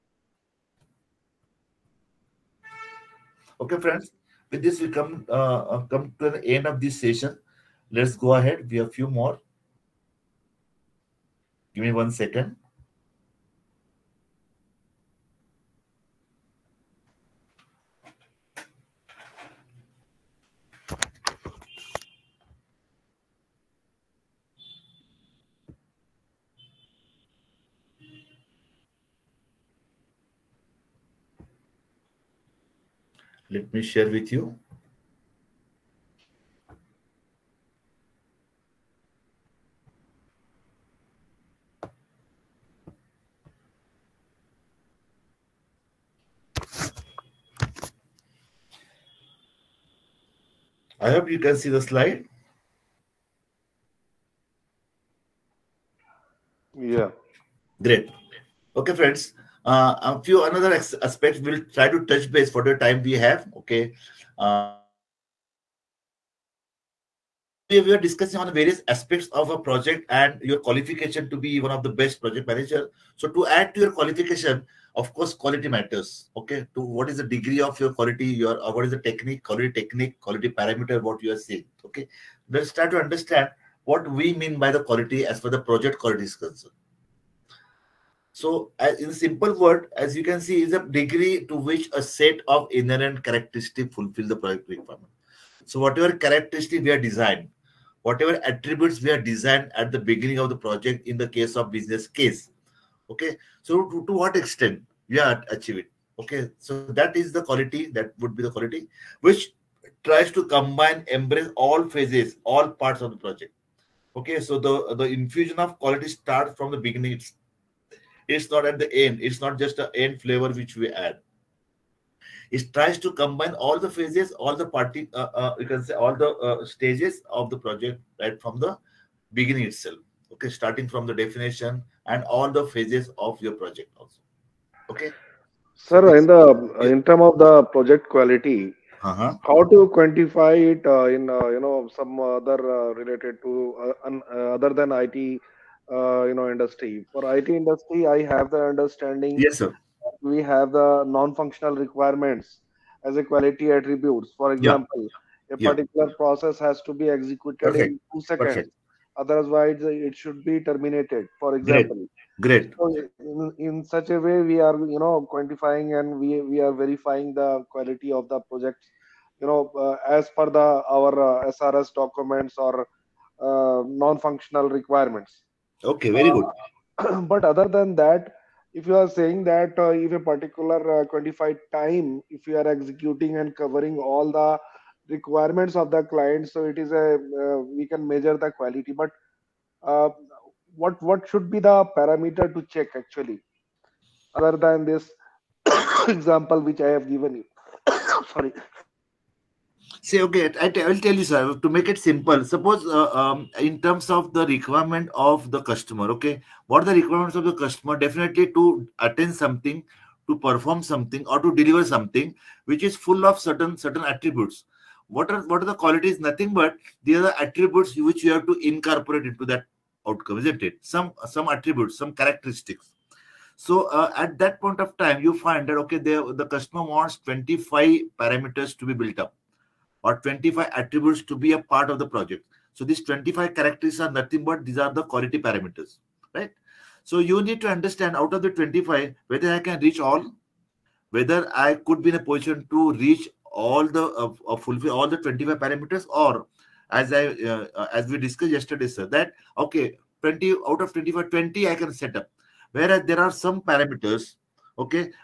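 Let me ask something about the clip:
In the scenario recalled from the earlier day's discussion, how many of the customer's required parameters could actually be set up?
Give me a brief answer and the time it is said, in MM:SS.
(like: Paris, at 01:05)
20, at 04:11.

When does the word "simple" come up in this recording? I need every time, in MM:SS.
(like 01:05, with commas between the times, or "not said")
01:29, 03:21.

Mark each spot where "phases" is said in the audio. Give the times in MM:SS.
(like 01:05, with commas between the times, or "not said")
01:51, 02:03, 02:12.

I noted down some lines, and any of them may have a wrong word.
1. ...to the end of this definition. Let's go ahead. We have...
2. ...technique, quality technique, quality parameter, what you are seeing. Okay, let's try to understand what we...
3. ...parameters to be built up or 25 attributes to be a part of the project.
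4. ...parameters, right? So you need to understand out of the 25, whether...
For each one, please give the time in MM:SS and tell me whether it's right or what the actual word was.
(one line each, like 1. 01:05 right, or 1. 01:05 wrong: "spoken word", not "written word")
1. 00:06 wrong: "session", not "definition"
2. 01:19 right
3. 03:48 right
4. 03:55 right.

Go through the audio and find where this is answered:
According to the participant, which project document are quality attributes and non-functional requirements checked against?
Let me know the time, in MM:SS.
02:51.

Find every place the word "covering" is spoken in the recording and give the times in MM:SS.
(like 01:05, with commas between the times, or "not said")
03:03.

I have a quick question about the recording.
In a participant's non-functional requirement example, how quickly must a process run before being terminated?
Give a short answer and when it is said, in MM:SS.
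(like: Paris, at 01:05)
2 seconds, at 02:38.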